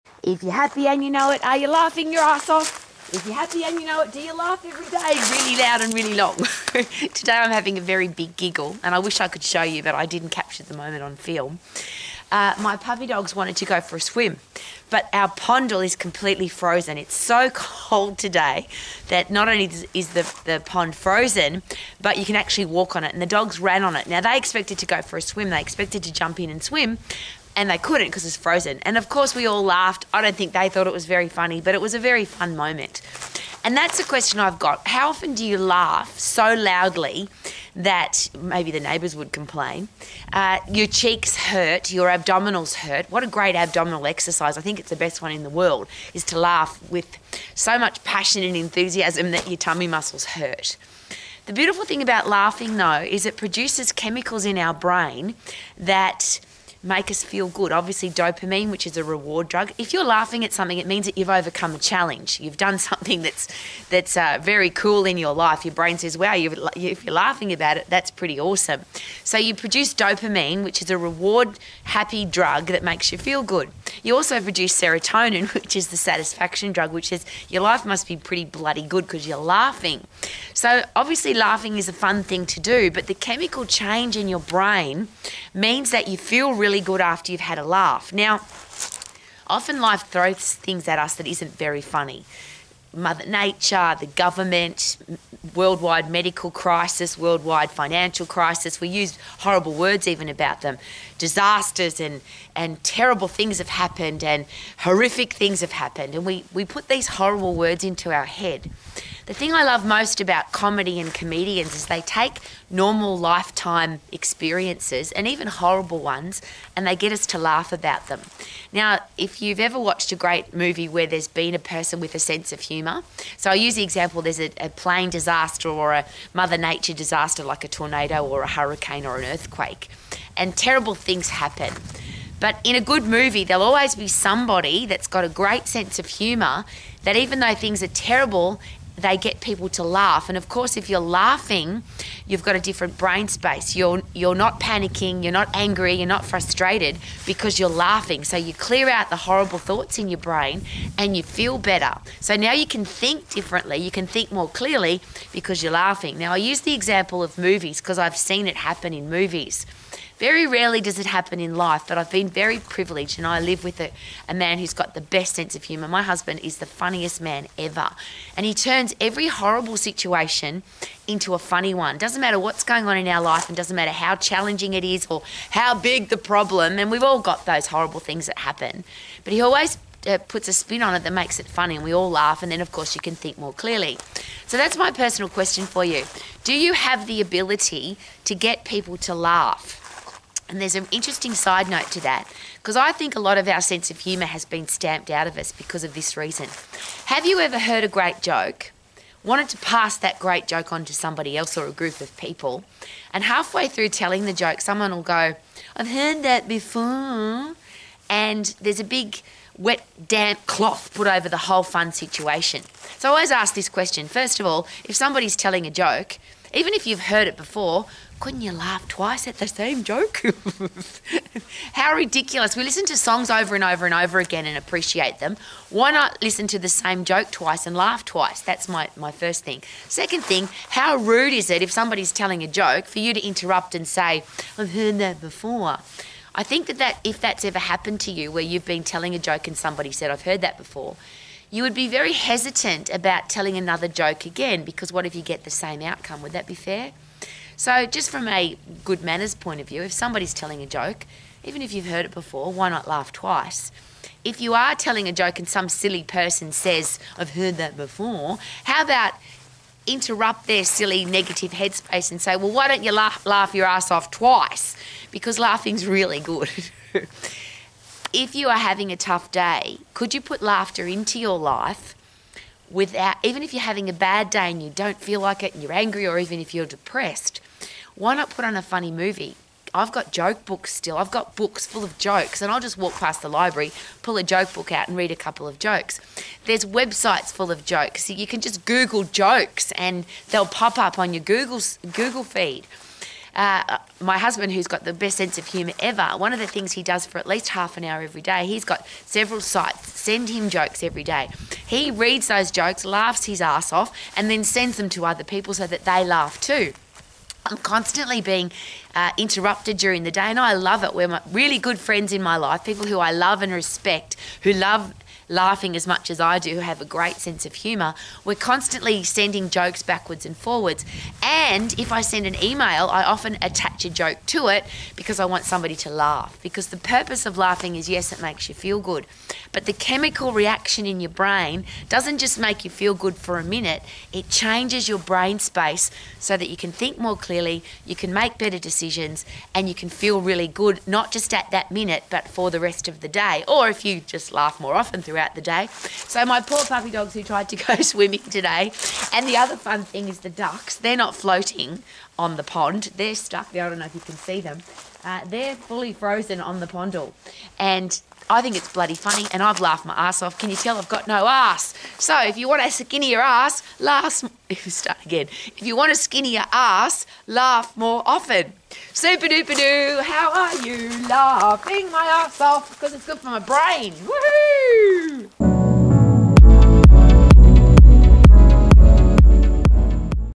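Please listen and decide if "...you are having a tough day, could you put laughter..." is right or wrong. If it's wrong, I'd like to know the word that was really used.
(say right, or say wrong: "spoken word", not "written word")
right.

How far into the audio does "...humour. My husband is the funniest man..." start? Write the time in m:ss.
2:45.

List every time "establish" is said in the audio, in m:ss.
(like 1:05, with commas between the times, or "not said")
not said.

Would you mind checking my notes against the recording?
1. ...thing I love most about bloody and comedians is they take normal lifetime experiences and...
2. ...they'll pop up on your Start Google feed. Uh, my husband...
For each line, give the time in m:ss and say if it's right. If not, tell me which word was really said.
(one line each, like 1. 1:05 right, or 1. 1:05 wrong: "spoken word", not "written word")
1. 1:49 wrong: "comedy", not "bloody"
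2. 4:50 wrong: "Google", not "Start".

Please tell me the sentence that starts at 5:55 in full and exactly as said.
Uh, they're fully frozen on the pondle.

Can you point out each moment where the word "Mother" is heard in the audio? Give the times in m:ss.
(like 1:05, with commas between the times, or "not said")
1:32, 2:06.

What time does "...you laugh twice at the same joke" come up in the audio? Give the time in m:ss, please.
3:38.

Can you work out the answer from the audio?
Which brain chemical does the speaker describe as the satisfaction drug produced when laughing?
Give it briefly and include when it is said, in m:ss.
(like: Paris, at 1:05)
serotonin, at 1:14.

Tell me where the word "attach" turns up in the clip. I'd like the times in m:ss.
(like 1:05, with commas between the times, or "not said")
5:23.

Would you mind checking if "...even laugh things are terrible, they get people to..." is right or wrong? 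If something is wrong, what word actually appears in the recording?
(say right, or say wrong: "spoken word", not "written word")
wrong: "though", not "laugh".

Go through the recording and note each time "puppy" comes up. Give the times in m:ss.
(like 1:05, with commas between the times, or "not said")
0:12, 5:46.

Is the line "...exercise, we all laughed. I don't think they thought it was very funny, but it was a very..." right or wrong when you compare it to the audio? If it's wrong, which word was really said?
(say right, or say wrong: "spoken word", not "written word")
wrong: "course", not "exercise".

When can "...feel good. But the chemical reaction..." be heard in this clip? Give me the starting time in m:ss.
5:28.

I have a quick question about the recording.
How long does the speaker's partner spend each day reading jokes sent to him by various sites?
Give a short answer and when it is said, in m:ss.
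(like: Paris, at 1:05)
Half an hour, at 4:57.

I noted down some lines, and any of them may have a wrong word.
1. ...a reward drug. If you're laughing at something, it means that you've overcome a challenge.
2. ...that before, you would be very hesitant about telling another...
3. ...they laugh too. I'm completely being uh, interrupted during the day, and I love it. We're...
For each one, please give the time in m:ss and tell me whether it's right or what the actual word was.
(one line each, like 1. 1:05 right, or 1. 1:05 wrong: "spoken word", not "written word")
1. 0:58 right
2. 4:00 right
3. 5:05 wrong: "constantly", not "completely".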